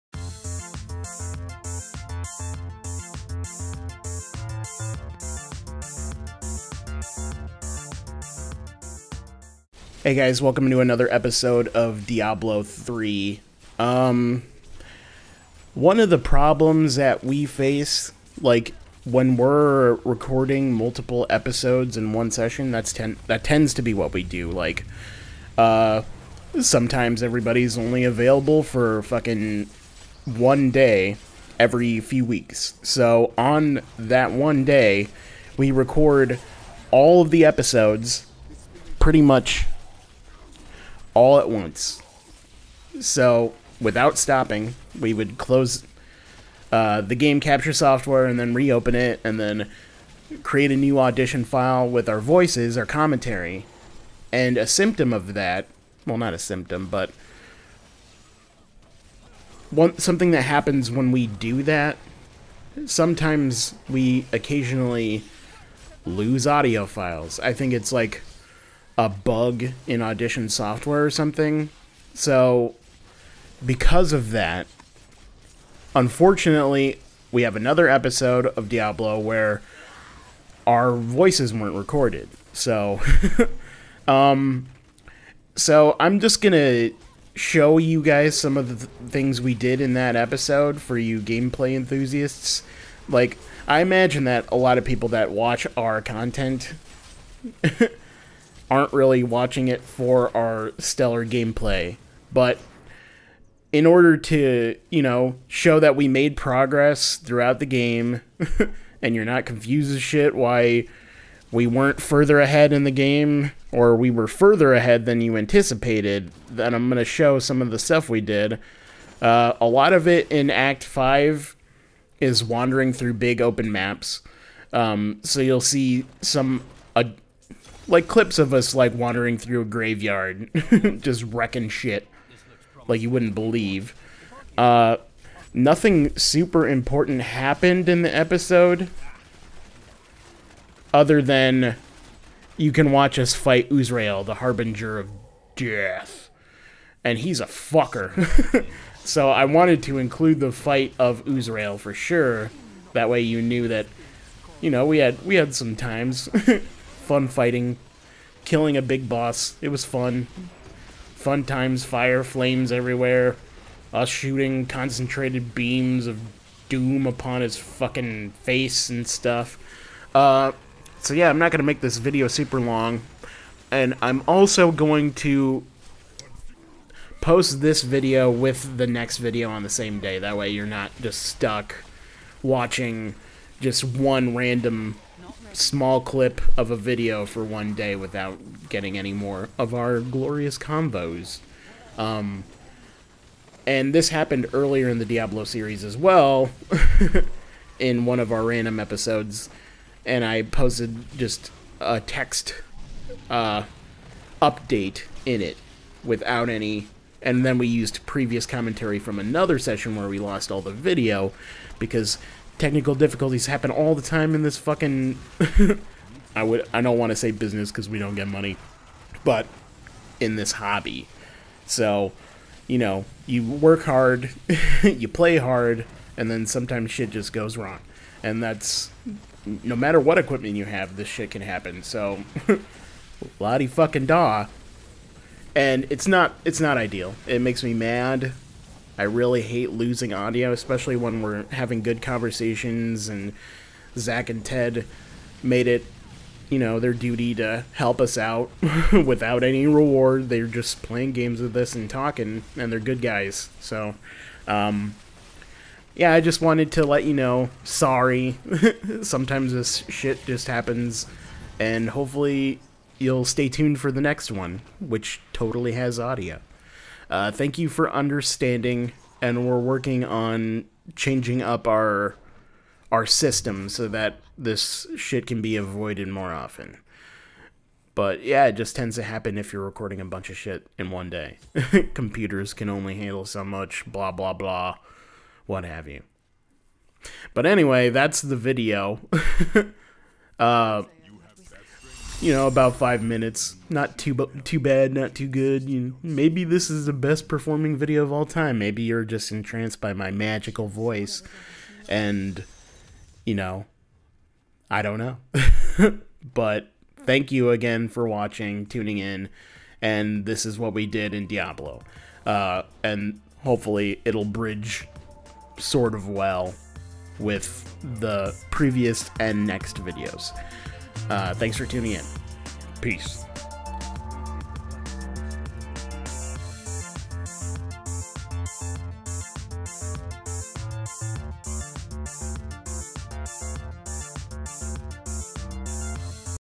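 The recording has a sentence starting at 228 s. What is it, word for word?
And that's no matter what equipment you have, this shit can happen.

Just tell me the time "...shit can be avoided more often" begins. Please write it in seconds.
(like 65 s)
274 s.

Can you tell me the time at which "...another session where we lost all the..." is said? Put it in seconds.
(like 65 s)
209 s.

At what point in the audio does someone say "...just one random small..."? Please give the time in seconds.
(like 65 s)
183 s.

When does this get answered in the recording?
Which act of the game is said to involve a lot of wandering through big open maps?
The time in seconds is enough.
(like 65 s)
120 s.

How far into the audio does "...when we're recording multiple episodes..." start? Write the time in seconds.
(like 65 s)
19 s.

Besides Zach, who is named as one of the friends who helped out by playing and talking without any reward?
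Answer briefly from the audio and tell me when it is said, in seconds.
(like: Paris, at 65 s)
Ted, at 244 s.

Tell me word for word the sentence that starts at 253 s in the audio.
So, um, yeah, I just wanted to let you know, sorry.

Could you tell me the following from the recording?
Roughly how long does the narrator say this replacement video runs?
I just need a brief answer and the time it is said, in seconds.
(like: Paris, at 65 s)
about 5 minutes, at 292 s.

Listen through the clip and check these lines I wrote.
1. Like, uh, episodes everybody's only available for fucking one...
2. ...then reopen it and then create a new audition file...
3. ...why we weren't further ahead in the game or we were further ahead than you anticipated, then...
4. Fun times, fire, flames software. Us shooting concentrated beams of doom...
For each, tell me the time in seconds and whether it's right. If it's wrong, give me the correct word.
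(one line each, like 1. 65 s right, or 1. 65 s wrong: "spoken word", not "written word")
1. 24 s wrong: "sometimes", not "episodes"
2. 48 s right
3. 110 s right
4. 161 s wrong: "everywhere", not "software".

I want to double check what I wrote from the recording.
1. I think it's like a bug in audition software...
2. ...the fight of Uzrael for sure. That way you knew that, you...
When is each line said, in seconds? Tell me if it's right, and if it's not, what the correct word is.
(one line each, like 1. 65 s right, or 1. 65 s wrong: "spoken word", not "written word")
1. 67 s right
2. 150 s right.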